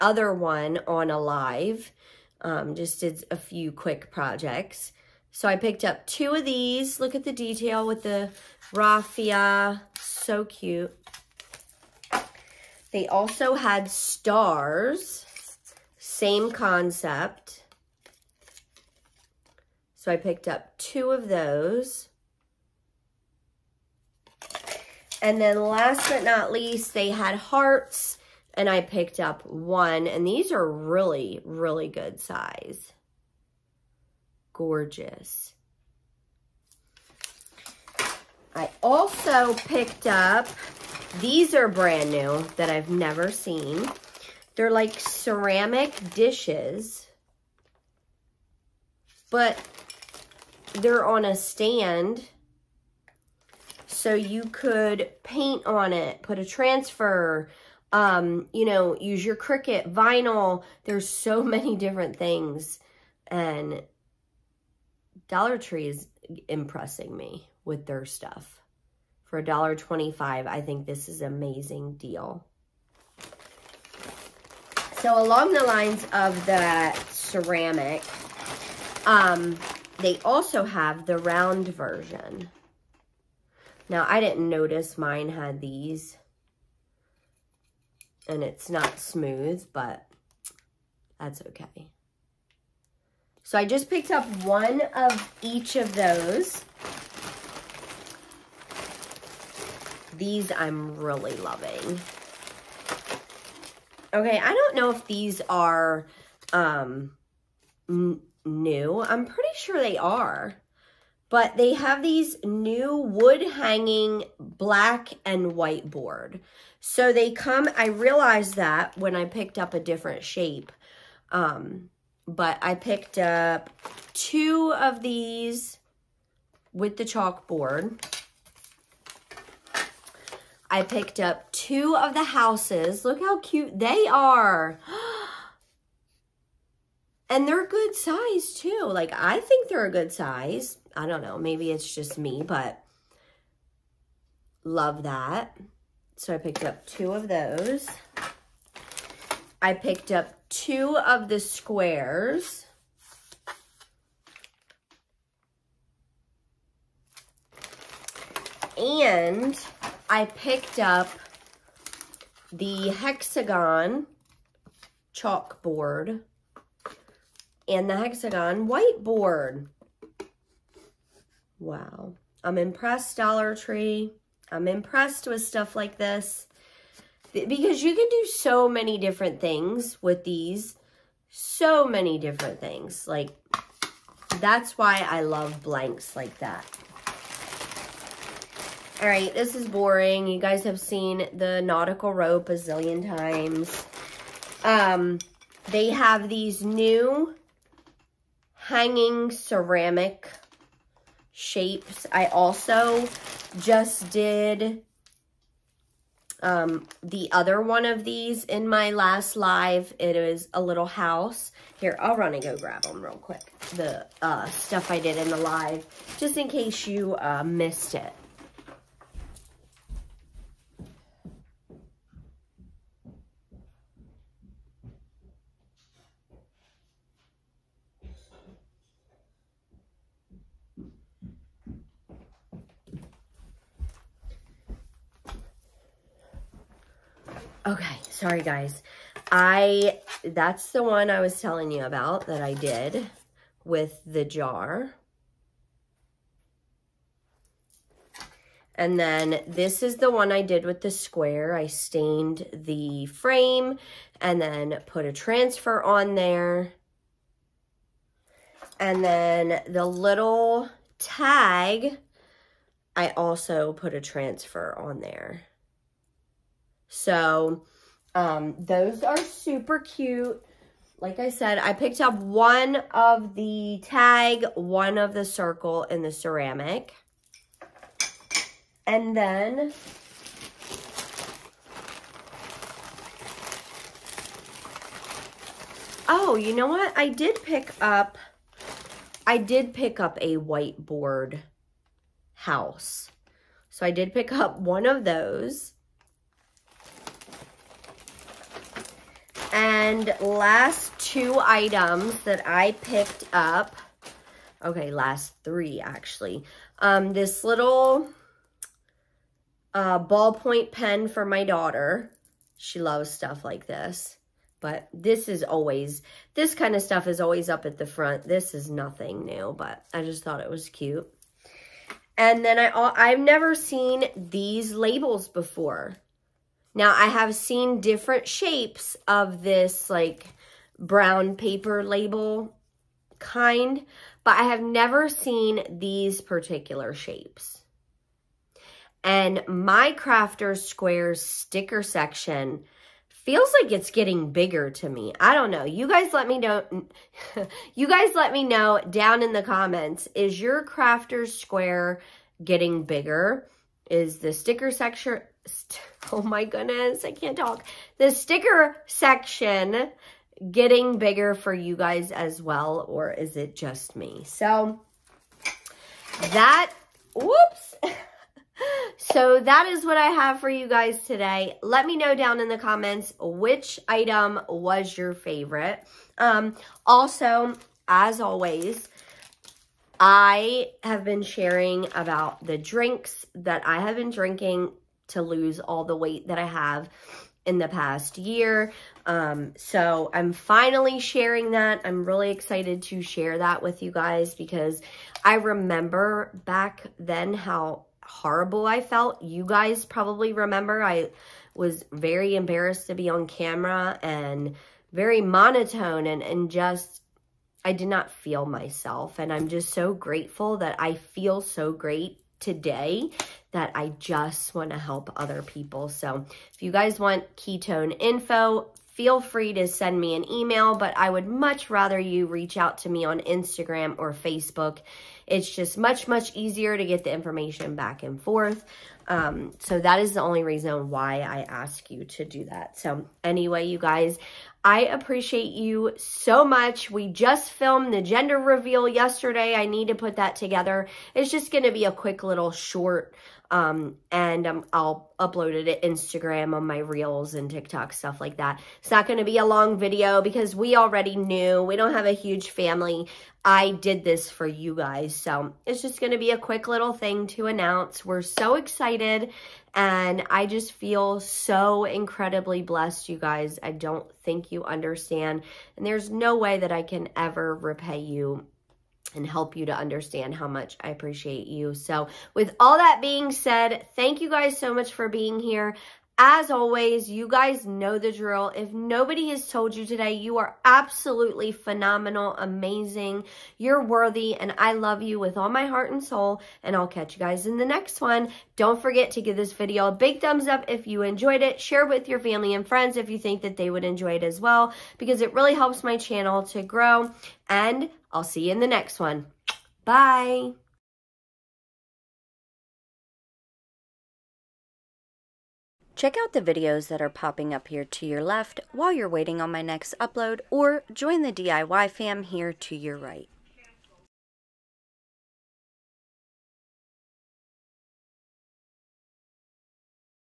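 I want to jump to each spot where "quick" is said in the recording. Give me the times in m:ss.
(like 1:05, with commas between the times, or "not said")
0:03, 3:33, 7:21, 7:36.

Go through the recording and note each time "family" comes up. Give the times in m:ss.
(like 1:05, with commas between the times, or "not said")
7:32, 8:12.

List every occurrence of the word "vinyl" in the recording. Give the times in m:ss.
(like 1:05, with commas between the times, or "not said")
0:59.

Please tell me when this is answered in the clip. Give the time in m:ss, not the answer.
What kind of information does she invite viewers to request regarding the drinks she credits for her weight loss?
6:57.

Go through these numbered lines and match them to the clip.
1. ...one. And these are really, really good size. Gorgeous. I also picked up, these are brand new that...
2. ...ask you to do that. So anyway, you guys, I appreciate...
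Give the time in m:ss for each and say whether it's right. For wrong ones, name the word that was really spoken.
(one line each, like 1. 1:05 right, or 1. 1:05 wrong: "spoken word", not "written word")
1. 0:29 right
2. 7:11 right.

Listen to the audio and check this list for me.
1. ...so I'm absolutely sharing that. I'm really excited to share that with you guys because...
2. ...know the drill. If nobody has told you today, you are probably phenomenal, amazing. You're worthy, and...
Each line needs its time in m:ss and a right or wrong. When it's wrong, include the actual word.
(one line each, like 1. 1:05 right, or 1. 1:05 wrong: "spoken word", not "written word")
1. 6:29 wrong: "finally", not "absolutely"
2. 7:57 wrong: "absolutely", not "probably".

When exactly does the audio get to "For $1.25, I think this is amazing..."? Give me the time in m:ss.
1:09.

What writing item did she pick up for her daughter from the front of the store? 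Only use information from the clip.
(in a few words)
ballpoint pen.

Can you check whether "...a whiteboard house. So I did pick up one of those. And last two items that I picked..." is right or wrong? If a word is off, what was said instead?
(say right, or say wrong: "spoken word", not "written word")
right.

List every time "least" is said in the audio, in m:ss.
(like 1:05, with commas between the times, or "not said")
0:26.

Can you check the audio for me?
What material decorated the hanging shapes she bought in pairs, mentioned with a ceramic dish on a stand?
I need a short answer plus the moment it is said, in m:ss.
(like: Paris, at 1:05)
raffia, at 0:08.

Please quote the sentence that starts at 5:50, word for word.
Is your Crafter Square getting bigger?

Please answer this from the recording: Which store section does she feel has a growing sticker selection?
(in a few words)
Crafter Squares.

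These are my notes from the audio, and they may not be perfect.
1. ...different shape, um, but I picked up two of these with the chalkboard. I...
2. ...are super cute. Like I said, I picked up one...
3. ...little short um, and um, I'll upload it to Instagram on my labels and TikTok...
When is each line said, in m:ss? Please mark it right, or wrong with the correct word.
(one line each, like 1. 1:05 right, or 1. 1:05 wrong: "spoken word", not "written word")
1. 1:59 right
2. 4:29 right
3. 7:22 wrong: "reels", not "labels".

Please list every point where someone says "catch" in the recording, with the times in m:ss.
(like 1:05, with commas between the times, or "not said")
8:06.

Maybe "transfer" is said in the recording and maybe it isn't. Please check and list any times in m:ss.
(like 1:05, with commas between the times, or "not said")
0:56, 4:15, 4:24.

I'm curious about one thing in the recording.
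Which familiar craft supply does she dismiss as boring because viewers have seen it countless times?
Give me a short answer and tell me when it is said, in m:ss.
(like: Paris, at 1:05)
nautical rope, at 3:11.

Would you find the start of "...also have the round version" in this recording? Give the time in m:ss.
1:20.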